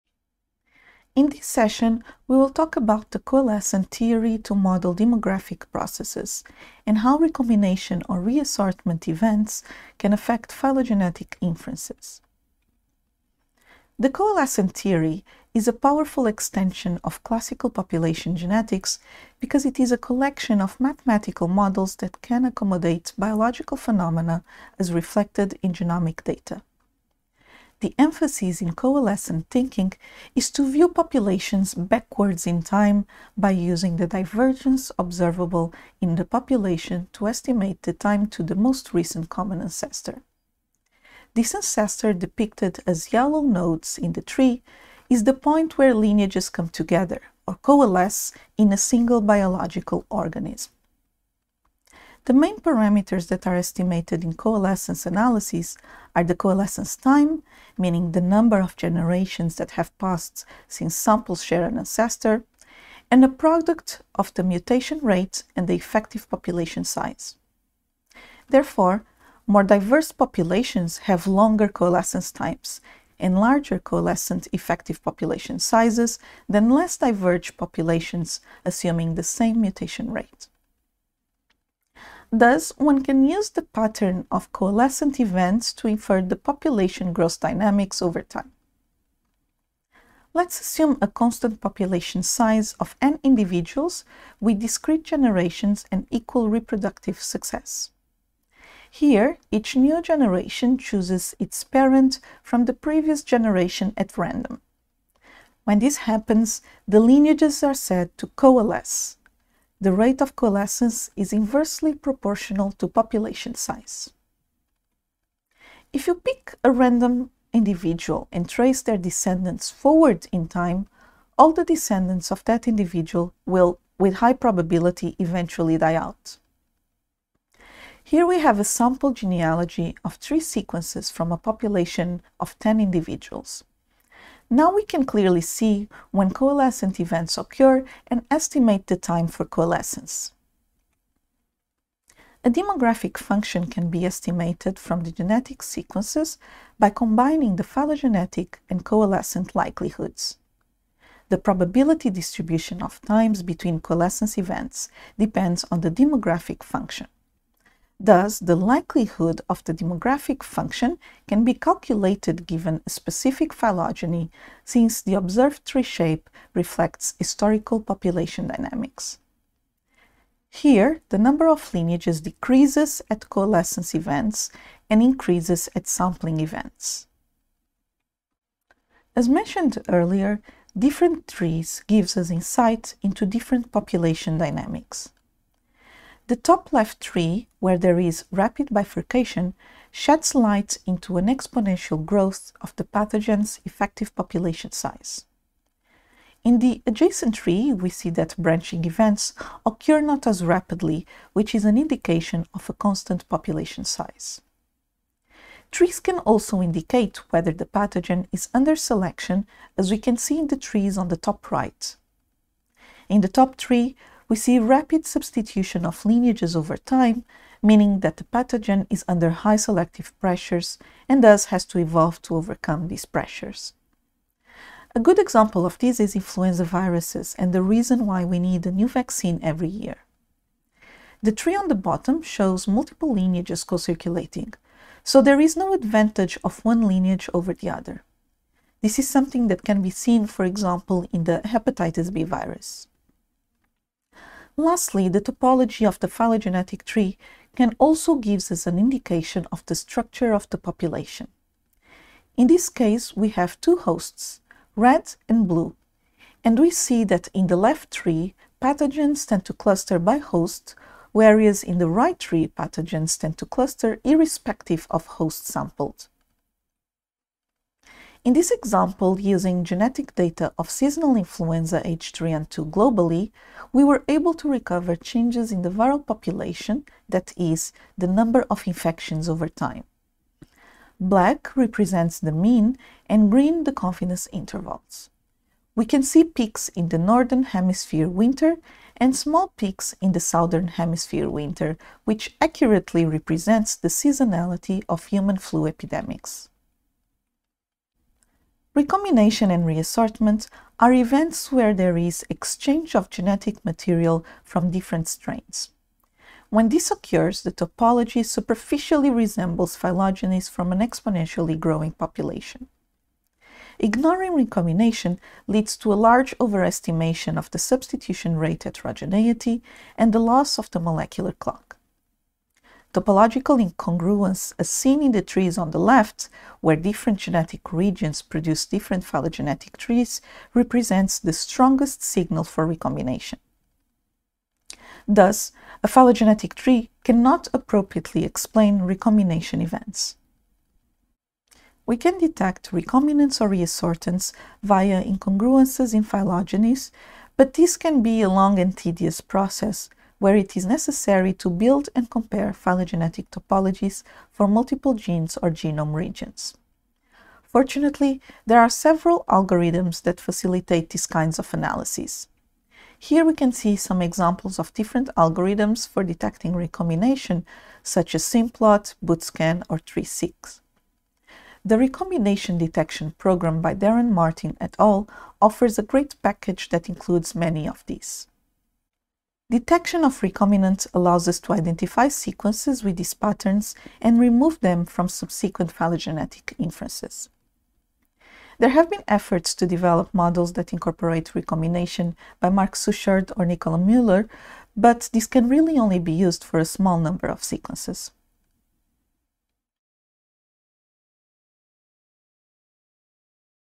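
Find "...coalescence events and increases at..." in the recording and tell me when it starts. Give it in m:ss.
2:53.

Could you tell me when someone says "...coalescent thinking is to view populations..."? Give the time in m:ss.
0:28.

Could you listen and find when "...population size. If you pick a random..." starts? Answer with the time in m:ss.
1:52.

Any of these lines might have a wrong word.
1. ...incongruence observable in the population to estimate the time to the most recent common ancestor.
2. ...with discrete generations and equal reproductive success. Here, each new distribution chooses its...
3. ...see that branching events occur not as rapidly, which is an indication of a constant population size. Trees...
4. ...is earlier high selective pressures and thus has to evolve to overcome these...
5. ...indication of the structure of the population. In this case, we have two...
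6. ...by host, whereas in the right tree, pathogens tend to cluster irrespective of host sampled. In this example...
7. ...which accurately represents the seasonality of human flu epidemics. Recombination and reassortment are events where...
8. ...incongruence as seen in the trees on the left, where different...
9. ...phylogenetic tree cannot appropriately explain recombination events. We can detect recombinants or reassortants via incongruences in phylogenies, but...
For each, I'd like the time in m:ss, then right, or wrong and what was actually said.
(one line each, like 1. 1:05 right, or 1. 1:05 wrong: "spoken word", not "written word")
1. 0:34 wrong: "divergence", not "incongruence"
2. 1:34 wrong: "generation", not "distribution"
3. 3:17 right
4. 3:38 wrong: "under", not "earlier"
5. 4:08 right
6. 4:19 right
7. 4:52 right
8. 5:23 right
9. 5:35 right.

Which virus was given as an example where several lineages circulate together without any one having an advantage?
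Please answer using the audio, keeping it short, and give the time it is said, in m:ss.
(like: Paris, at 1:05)
hepatitis B virus, at 4:01.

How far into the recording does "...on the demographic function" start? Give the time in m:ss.
2:35.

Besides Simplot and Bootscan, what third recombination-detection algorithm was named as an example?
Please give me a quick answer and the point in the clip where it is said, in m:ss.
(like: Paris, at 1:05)
3Seq, at 6:09.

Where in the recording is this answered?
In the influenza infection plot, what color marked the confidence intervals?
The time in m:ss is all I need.
4:43.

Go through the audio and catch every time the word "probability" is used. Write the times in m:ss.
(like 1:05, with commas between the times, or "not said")
2:04, 2:31.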